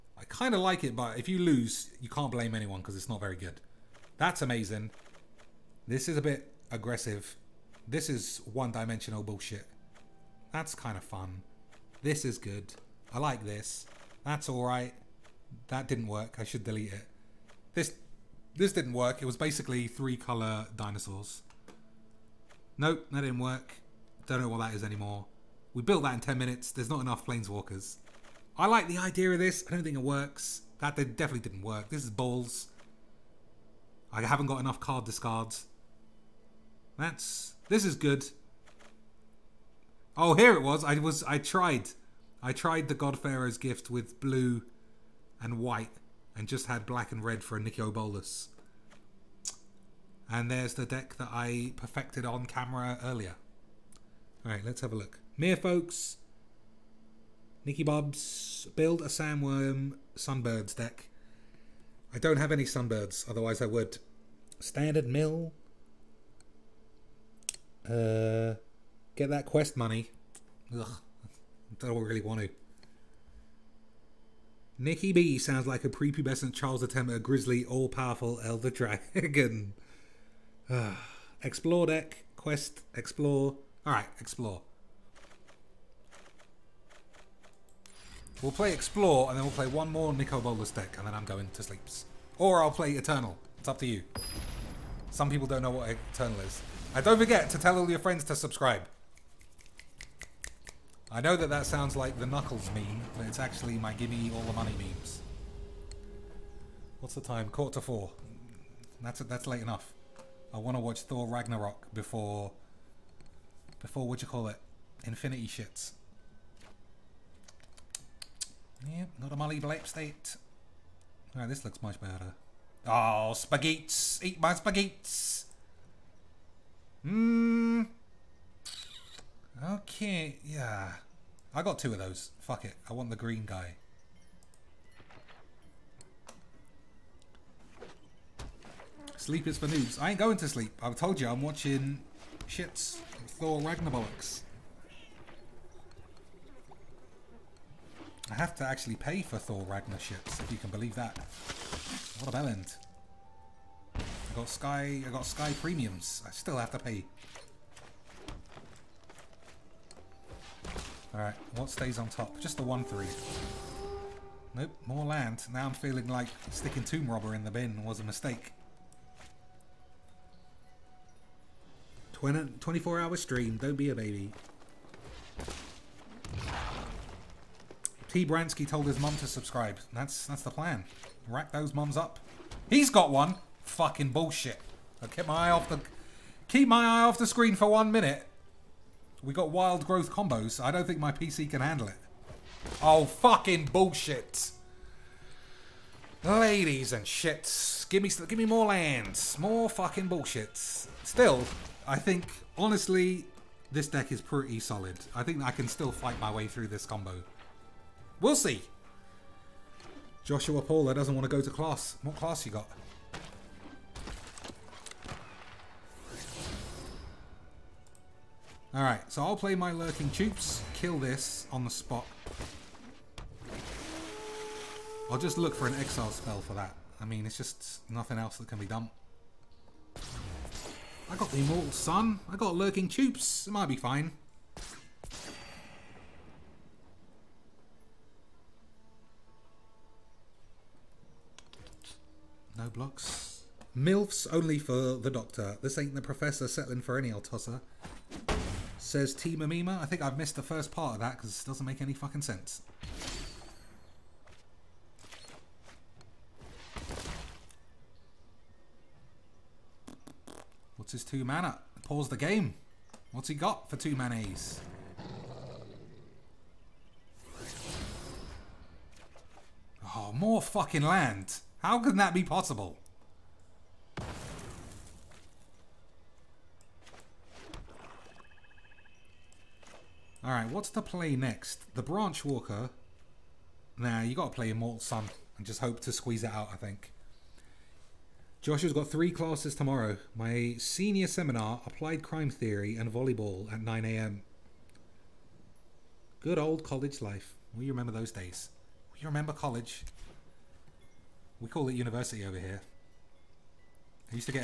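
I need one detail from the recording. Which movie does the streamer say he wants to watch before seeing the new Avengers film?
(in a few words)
Thor Ragnarok.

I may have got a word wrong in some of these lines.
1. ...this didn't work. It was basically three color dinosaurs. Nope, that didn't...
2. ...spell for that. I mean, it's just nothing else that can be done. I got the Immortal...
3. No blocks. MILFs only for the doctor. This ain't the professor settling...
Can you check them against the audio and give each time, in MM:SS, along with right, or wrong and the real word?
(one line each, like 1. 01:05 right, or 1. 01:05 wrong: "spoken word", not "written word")
1. 00:18 right
2. 03:46 right
3. 04:02 right.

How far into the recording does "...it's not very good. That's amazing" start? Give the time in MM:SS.
00:02.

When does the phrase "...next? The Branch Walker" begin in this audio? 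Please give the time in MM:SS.
04:41.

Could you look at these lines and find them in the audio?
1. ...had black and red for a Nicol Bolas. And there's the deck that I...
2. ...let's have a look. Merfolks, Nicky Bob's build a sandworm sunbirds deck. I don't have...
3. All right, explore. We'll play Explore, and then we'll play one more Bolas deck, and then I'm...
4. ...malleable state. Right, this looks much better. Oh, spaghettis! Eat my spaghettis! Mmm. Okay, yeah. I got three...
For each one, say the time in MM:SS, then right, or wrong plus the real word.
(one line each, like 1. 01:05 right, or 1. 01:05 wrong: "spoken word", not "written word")
1. 00:46 right
2. 00:54 right
3. 01:23 right
4. 01:59 wrong: "two", not "three".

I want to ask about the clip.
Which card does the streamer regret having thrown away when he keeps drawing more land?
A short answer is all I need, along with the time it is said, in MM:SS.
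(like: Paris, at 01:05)
Tomb Robber, at 02:46.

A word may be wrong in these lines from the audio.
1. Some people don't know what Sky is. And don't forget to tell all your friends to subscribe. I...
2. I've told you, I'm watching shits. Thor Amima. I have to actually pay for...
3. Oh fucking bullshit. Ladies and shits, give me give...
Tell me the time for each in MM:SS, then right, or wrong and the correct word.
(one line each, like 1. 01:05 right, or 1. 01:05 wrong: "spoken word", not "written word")
1. 01:35 wrong: "Eternal", not "Sky"
2. 02:20 wrong: "Ragnaroks", not "Amima"
3. 03:12 right.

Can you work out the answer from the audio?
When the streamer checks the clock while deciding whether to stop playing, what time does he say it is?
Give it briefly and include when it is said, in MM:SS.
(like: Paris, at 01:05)
Quarter to four, at 01:47.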